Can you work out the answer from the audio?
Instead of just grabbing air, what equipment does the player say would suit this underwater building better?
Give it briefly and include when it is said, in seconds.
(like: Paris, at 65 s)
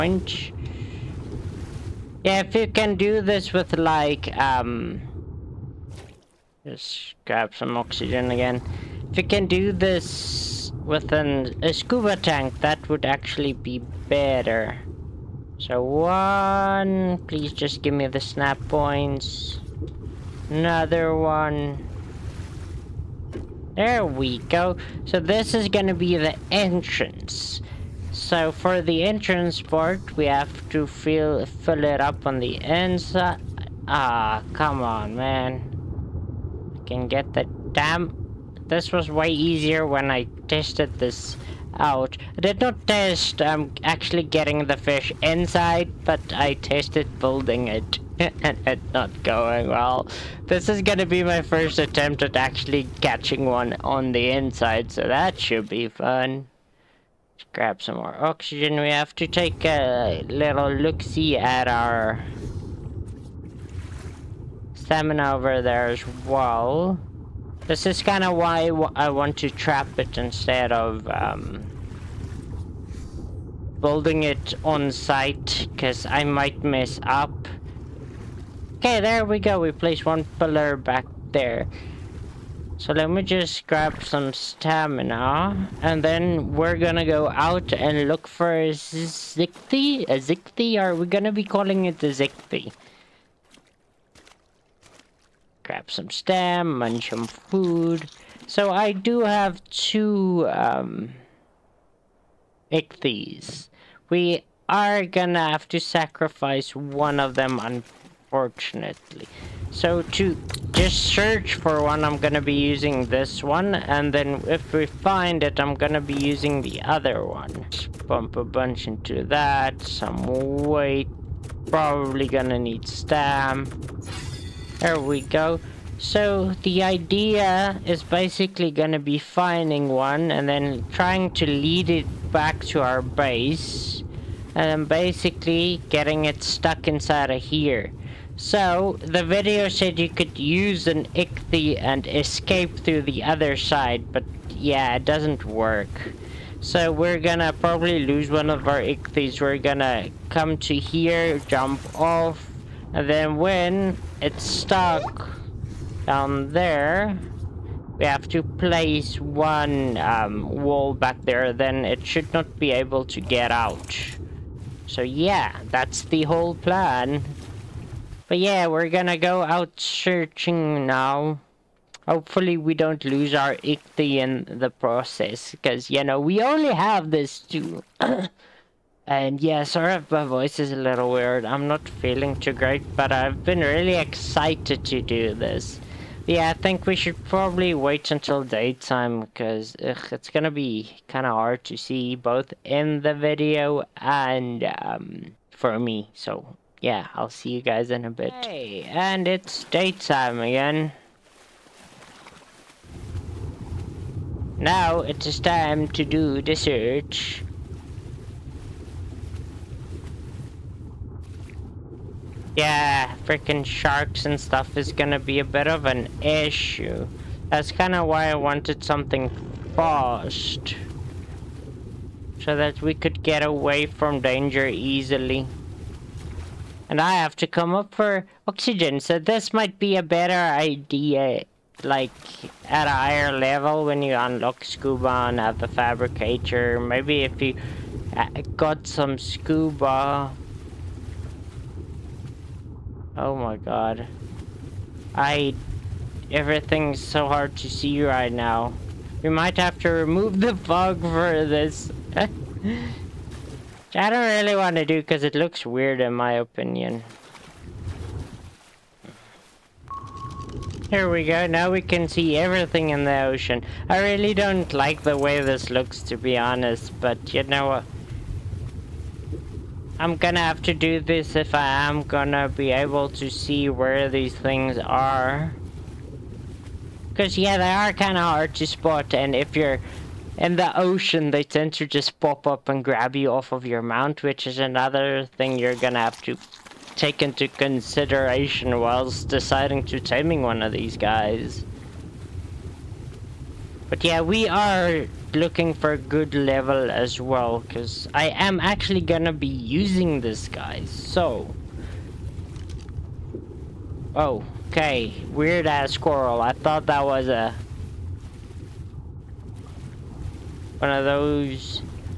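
scuba tank, at 11 s.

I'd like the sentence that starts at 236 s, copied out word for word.
Maybe if you uh, got some scuba...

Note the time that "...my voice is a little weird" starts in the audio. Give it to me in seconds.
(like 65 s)
180 s.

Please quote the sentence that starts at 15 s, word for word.
So one, please just give me the snap points.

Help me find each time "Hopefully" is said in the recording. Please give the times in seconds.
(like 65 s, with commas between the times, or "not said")
172 s.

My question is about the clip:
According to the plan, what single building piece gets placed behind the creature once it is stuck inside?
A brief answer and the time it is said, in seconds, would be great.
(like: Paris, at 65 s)
wall, at 160 s.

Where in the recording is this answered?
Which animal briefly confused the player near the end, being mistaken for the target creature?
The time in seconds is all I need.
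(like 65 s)
305 s.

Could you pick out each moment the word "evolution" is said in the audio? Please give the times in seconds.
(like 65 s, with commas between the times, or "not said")
not said.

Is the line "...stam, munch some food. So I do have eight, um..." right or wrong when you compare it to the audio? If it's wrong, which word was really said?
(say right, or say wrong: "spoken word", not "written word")
wrong: "two", not "eight".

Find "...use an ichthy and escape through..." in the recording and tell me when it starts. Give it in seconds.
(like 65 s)
140 s.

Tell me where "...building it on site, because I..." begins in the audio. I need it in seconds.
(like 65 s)
73 s.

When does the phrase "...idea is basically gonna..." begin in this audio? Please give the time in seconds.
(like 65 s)
126 s.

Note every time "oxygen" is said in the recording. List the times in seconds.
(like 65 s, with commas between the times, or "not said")
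7 s, 58 s, 228 s.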